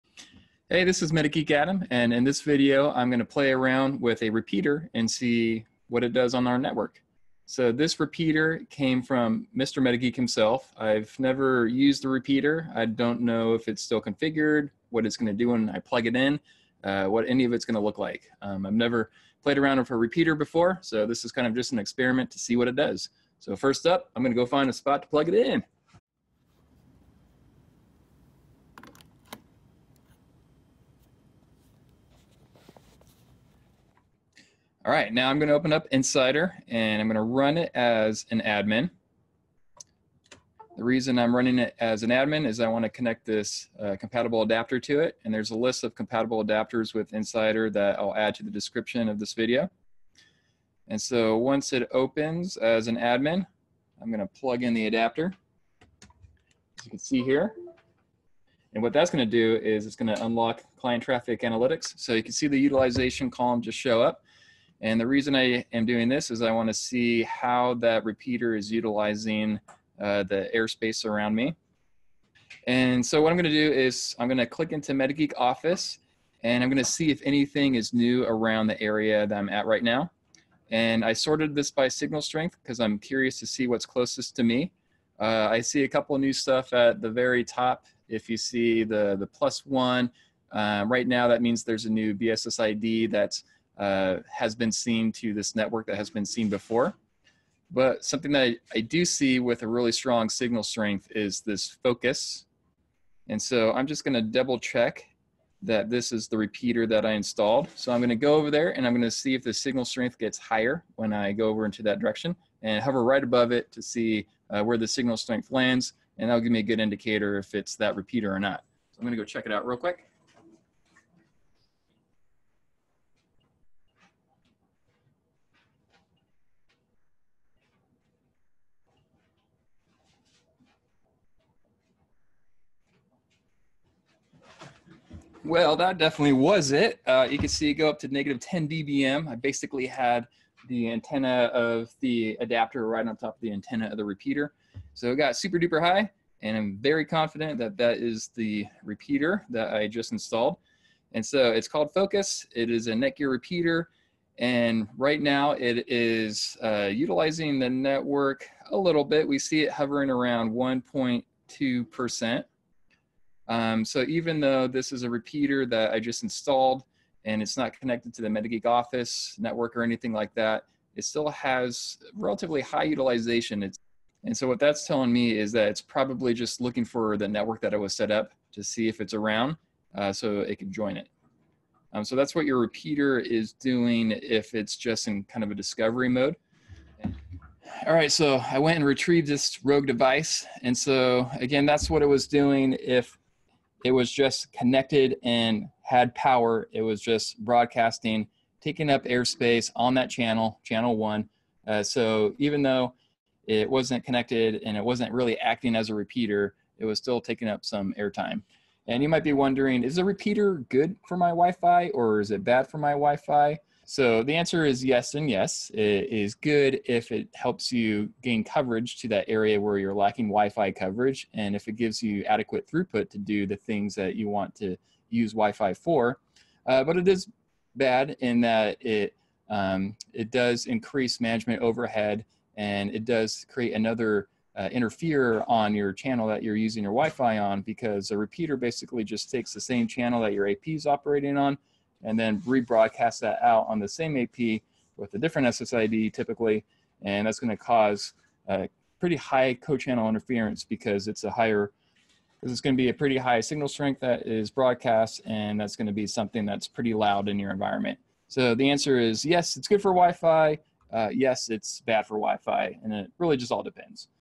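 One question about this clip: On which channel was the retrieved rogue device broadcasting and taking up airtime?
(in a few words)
1.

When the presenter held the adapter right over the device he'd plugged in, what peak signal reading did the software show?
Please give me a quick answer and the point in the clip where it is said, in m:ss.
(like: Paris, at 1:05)
-10 dBm, at 2:18.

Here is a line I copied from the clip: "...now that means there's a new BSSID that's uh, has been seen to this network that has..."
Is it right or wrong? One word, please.
right.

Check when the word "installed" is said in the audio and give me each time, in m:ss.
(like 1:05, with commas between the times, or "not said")
1:47, 2:30, 2:46.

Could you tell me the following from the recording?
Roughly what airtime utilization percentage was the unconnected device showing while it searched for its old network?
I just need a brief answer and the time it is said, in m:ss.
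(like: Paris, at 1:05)
1.2%, at 2:40.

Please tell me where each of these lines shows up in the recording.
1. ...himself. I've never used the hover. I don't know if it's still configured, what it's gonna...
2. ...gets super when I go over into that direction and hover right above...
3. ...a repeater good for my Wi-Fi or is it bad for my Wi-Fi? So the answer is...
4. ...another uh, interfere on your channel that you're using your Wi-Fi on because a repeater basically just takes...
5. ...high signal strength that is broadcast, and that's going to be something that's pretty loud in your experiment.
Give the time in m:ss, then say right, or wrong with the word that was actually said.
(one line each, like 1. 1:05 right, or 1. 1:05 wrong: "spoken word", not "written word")
1. 0:10 wrong: "repeater", not "hover"
2. 1:50 wrong: "higher", not "super"
3. 3:29 right
4. 3:53 right
5. 4:13 wrong: "environment", not "experiment".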